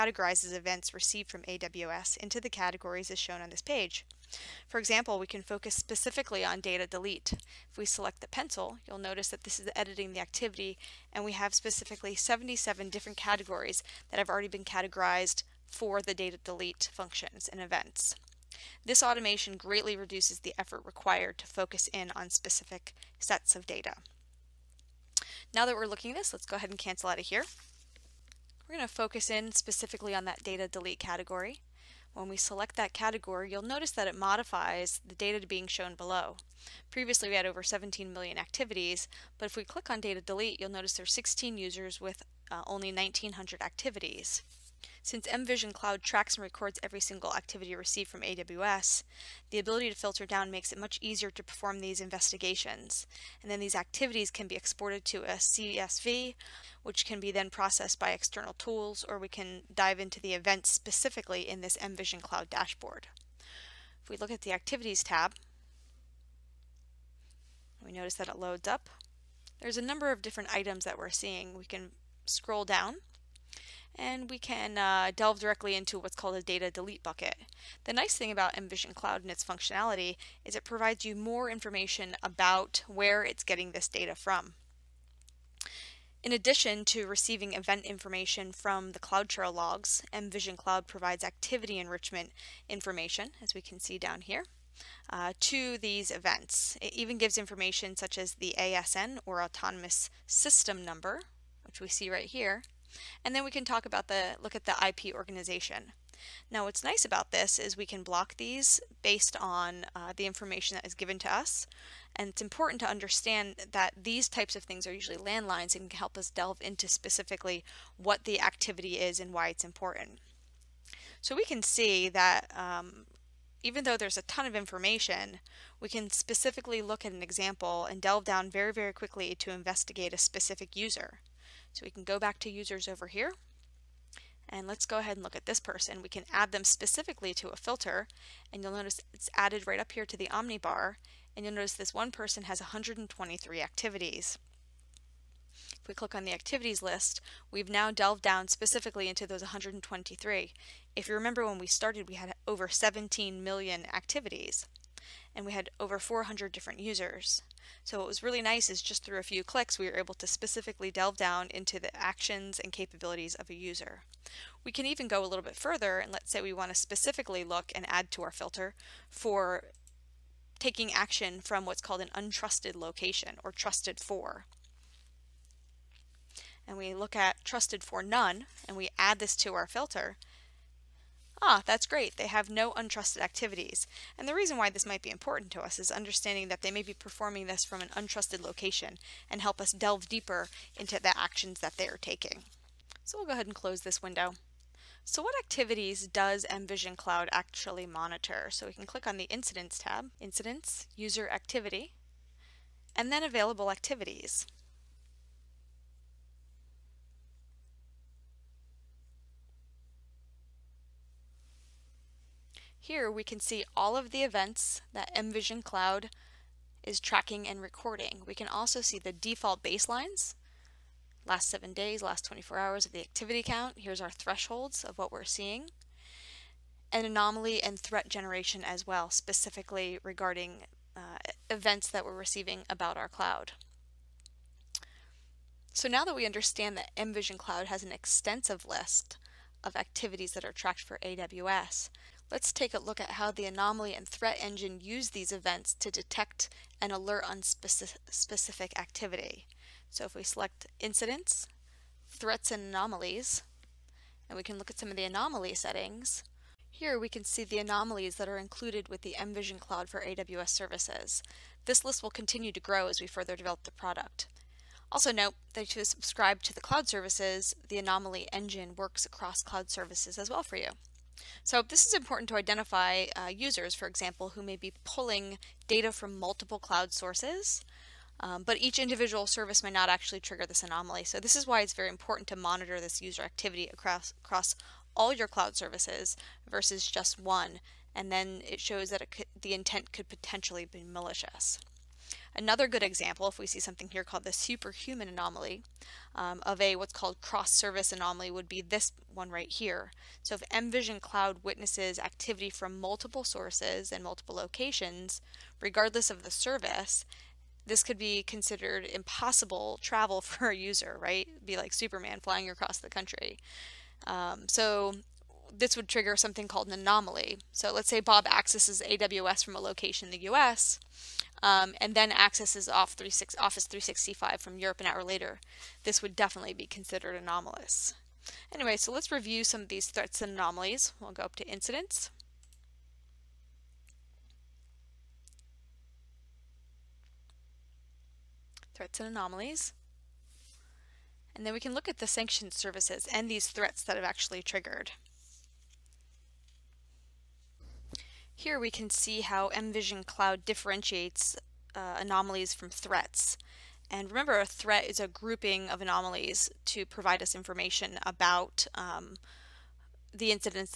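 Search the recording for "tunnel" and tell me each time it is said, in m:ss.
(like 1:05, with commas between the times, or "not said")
not said.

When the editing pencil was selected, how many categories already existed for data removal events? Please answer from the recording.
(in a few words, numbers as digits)
77.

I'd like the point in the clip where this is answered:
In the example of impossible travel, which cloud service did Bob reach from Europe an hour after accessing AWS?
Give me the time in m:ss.
5:22.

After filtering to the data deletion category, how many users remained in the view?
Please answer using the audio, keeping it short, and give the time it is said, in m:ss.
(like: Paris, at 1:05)
16, at 0:41.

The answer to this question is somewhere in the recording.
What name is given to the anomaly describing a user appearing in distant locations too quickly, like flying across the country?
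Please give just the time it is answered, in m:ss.
4:54.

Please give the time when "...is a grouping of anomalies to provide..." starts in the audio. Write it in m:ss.
5:54.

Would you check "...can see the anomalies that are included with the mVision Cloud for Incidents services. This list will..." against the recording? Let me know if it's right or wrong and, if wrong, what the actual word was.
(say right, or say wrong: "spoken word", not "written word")
wrong: "AWS", not "Incidents".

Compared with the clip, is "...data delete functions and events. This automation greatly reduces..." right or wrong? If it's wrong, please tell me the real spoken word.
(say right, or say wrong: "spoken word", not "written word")
right.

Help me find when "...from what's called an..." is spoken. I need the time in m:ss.
2:51.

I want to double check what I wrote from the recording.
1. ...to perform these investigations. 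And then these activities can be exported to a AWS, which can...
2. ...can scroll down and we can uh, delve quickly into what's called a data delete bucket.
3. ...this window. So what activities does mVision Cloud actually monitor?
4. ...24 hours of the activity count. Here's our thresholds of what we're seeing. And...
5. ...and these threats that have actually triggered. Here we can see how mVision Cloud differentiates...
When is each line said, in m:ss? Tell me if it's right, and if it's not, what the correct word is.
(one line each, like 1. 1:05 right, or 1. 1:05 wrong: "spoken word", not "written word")
1. 0:51 wrong: "CSV", not "AWS"
2. 1:11 wrong: "directly", not "quickly"
3. 3:13 right
4. 3:42 right
5. 5:43 right.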